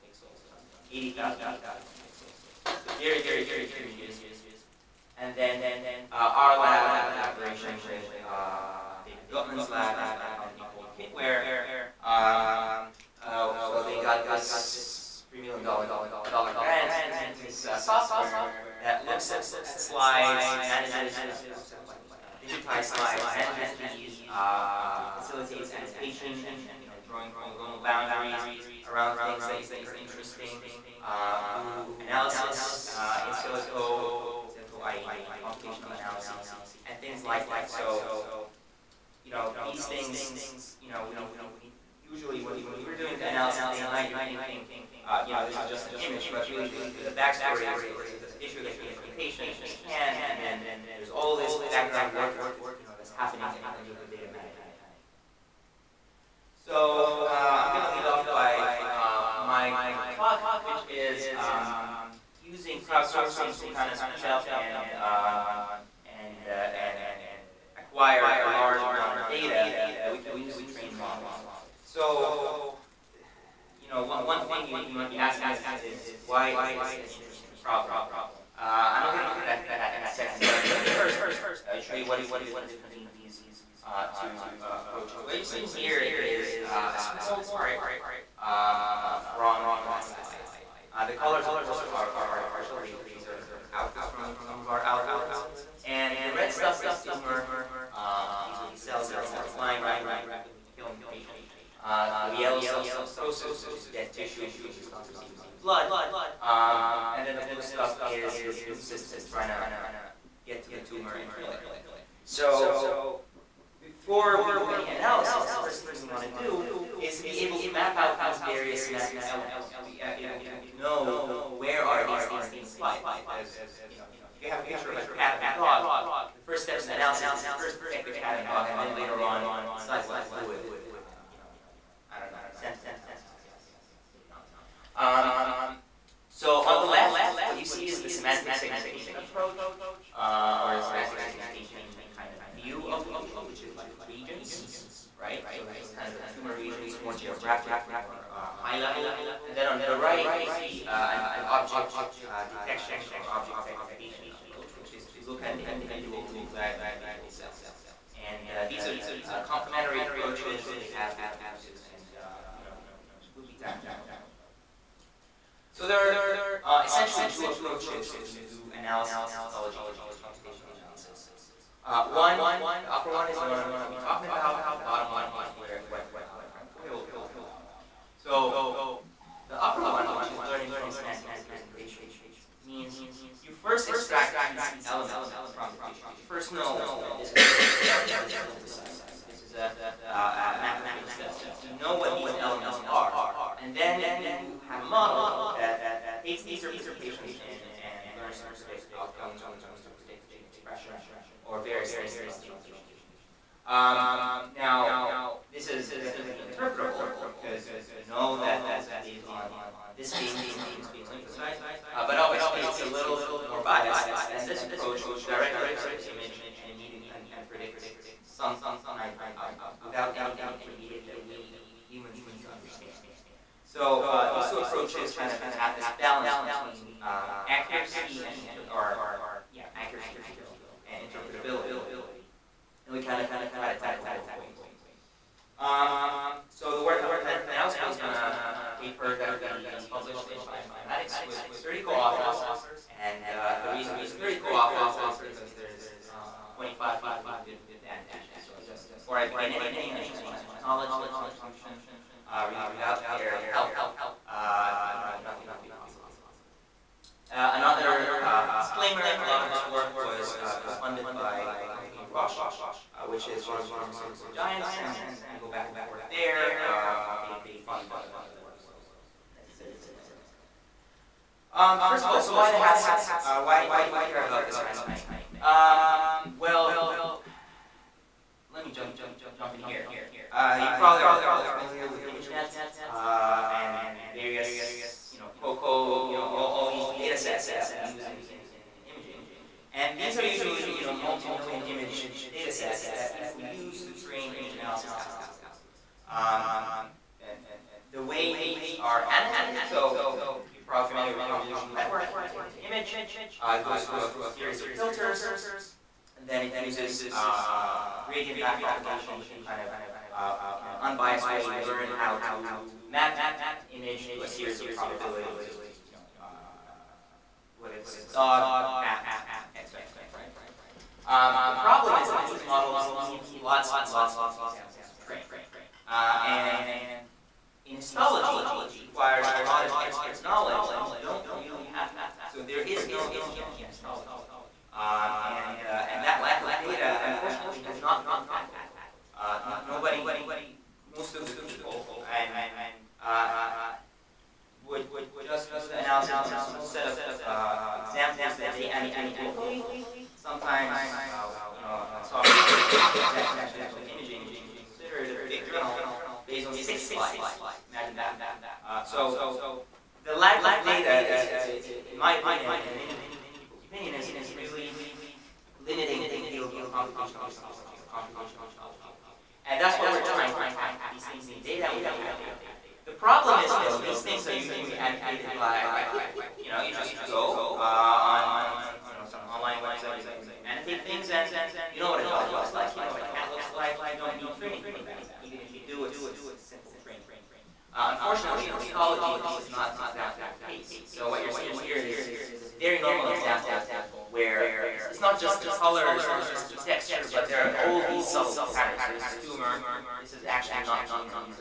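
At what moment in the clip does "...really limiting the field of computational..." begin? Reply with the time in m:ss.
6:04.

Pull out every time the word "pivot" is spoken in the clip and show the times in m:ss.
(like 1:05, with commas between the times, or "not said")
not said.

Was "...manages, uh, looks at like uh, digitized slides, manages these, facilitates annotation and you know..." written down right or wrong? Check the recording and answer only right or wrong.
right.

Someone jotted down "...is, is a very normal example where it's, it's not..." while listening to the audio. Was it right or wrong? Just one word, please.
right.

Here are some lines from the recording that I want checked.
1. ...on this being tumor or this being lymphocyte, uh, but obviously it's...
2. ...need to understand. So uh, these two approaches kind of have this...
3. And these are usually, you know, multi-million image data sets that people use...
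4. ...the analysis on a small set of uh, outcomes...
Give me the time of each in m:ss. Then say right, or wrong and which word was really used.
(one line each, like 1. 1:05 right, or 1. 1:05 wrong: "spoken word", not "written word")
1. 3:29 right
2. 3:42 right
3. 4:49 right
4. 5:45 wrong: "examples", not "outcomes".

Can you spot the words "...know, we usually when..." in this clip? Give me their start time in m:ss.
0:40.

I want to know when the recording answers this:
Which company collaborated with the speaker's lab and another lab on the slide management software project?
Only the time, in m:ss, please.
0:10.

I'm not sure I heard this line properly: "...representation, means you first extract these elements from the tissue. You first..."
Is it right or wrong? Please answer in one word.
right.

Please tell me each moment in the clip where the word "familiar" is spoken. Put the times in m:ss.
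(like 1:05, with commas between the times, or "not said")
4:41, 5:00.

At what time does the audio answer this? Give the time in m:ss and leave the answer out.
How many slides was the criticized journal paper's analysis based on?
5:56.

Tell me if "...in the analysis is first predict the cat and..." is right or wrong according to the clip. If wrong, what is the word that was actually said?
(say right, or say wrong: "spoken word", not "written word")
wrong: "detect", not "predict".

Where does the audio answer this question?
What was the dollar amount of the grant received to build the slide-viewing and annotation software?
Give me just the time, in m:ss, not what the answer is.
0:15.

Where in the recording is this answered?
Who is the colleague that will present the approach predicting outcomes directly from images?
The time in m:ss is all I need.
2:56.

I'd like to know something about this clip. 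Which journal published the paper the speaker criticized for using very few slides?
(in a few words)
Transactions of Medical Imaging.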